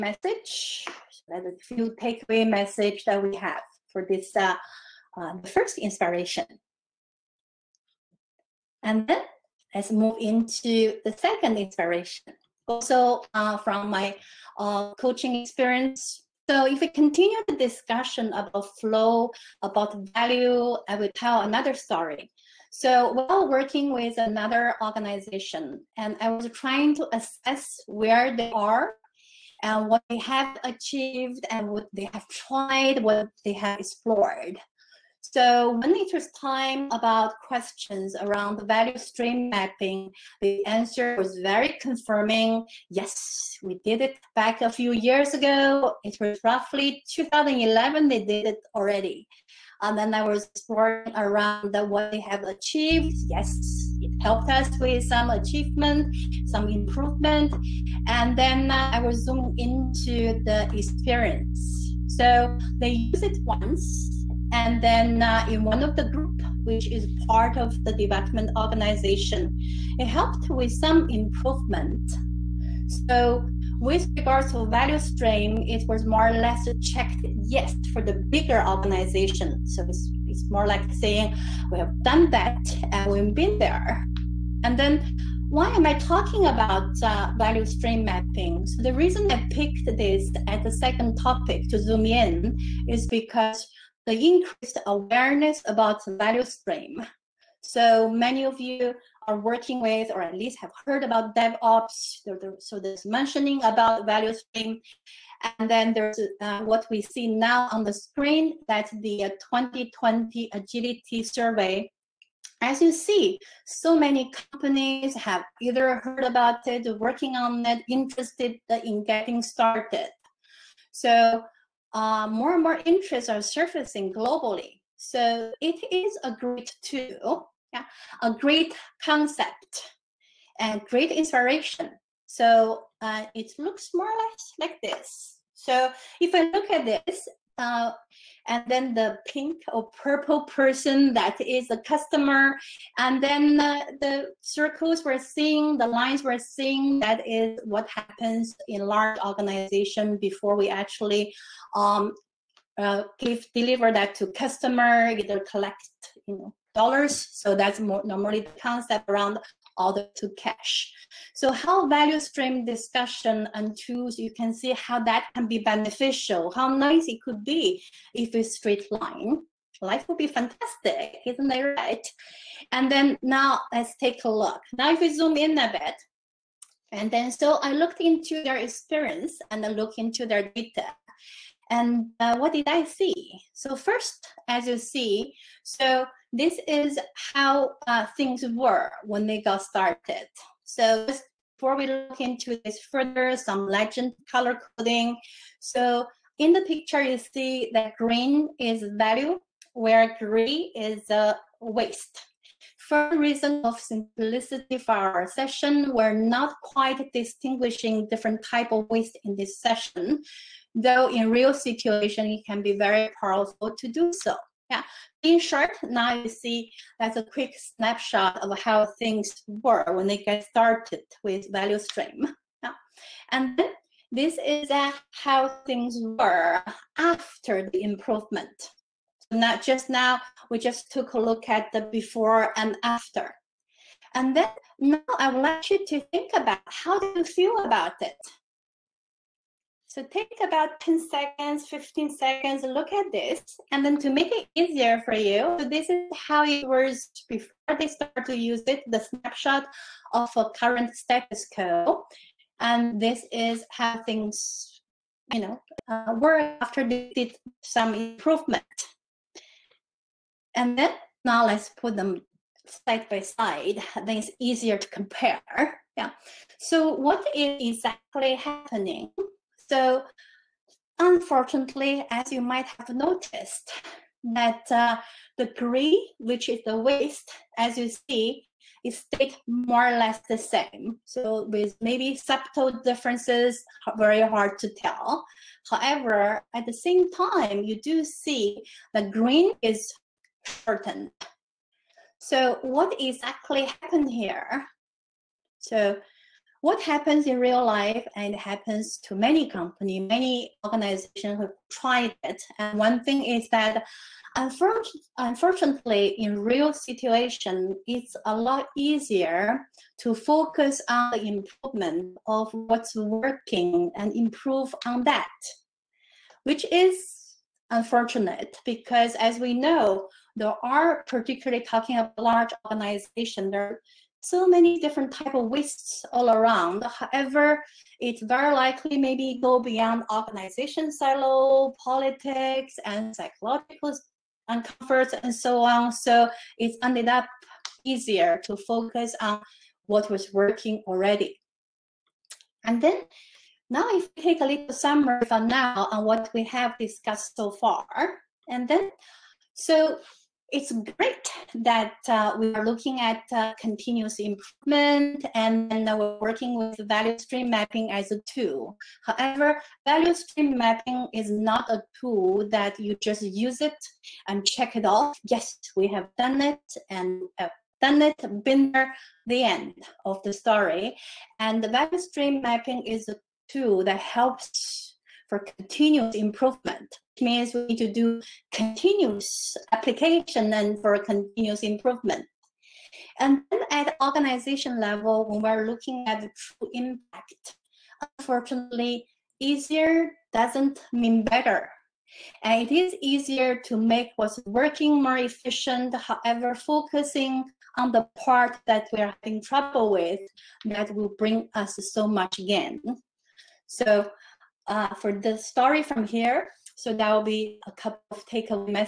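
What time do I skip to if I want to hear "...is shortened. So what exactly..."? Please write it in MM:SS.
04:49.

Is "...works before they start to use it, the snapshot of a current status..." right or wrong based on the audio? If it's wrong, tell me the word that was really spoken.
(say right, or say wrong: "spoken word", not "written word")
right.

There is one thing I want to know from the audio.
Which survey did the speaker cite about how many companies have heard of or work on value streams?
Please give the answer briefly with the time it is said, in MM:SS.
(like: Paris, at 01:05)
2020 Agility Survey, at 01:49.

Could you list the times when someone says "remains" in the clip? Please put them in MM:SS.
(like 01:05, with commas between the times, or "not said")
not said.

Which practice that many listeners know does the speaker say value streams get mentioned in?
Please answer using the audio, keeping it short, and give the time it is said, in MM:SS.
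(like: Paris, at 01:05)
DevOps, at 01:41.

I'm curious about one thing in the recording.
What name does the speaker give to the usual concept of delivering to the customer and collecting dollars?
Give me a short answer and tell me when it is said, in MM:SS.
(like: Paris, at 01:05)
order to cash, at 02:39.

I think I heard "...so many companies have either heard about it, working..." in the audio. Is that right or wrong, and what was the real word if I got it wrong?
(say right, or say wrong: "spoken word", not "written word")
right.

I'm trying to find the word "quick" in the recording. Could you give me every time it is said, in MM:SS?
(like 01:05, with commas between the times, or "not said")
03:37.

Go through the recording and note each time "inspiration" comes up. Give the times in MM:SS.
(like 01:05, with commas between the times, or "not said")
00:05, 00:11, 02:11.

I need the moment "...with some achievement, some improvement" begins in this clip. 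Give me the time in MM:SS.
00:54.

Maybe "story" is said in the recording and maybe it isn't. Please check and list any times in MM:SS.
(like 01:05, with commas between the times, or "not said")
00:21, 06:10, 06:45.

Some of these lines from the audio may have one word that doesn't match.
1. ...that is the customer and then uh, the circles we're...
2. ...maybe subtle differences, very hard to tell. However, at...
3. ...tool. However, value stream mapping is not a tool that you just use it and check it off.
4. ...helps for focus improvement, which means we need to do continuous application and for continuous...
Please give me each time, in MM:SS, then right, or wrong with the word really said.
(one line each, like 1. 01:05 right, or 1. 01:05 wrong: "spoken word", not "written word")
1. 02:21 right
2. 04:41 right
3. 05:58 right
4. 06:13 wrong: "continuous", not "focus".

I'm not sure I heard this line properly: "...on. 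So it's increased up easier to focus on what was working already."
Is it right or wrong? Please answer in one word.
wrong.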